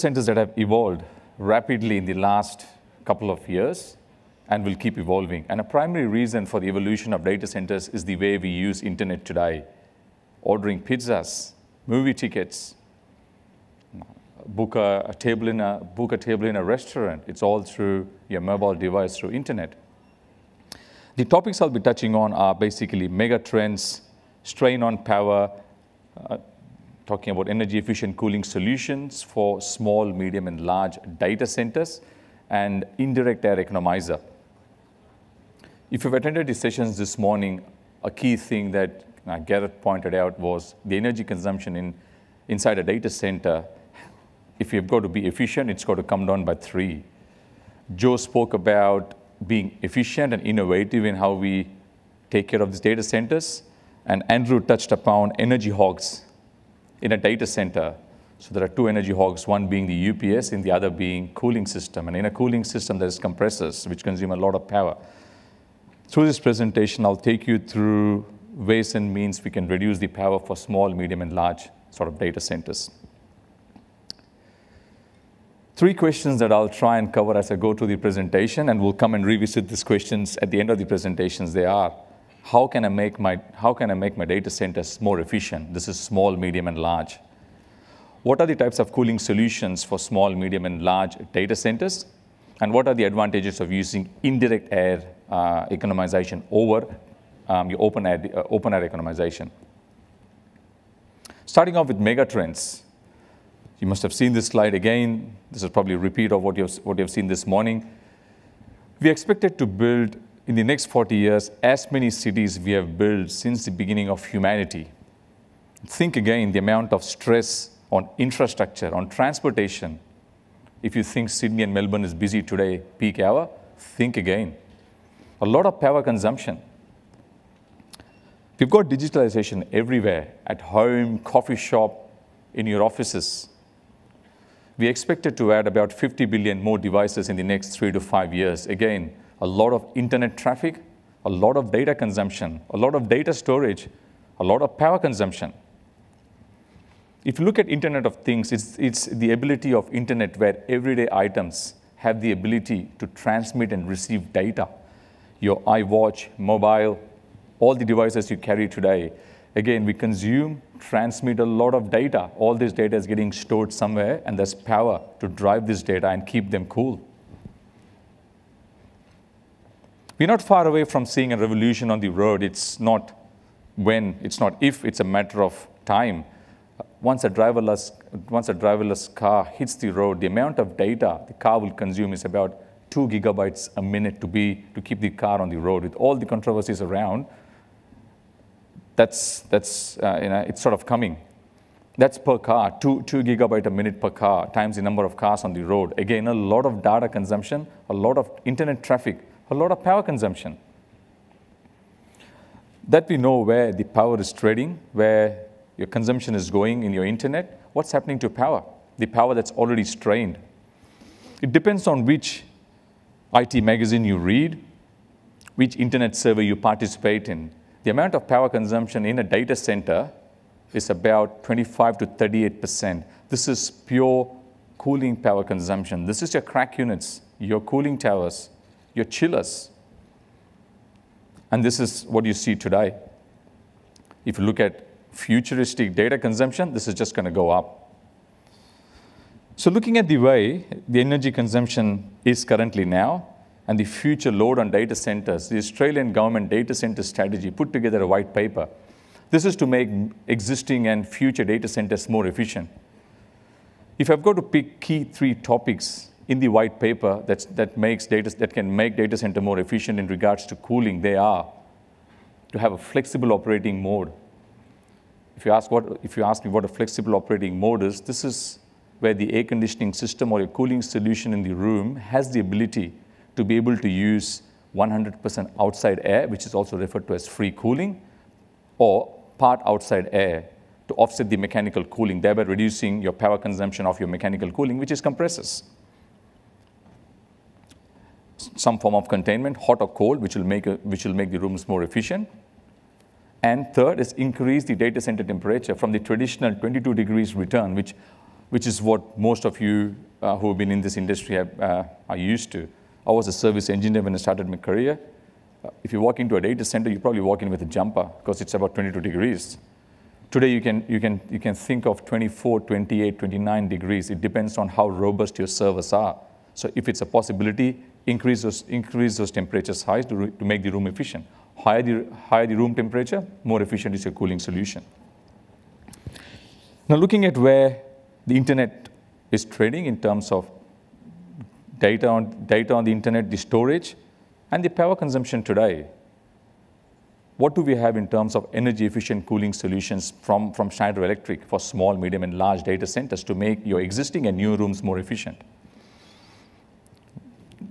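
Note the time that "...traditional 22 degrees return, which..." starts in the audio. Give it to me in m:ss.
4:55.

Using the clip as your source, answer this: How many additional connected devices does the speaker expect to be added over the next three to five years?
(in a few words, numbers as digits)
50 billion.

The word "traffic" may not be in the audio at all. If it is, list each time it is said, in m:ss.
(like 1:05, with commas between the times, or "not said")
2:20, 3:18.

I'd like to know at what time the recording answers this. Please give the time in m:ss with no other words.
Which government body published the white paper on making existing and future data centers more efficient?
4:05.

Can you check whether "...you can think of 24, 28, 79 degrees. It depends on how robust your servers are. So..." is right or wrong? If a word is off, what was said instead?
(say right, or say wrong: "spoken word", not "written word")
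wrong: "29", not "79".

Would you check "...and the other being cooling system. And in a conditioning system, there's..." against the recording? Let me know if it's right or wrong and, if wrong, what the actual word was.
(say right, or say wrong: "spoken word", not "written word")
wrong: "cooling", not "conditioning".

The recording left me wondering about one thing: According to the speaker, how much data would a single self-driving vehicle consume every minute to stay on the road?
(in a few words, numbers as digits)
2 gigabytes.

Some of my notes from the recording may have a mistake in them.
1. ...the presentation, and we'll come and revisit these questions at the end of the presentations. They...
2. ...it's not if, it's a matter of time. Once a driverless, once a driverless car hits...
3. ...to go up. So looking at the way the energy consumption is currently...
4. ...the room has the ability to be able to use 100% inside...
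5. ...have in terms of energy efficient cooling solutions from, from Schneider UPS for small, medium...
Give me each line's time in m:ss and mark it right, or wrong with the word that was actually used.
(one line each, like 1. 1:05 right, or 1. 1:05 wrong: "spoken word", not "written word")
1. 1:17 right
2. 2:54 right
3. 3:57 right
4. 4:31 wrong: "outside", not "inside"
5. 5:37 wrong: "Electric", not "UPS".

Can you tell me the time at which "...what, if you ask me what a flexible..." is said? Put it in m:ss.
4:25.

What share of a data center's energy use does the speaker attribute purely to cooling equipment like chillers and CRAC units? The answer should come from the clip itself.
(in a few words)
25 to 38%.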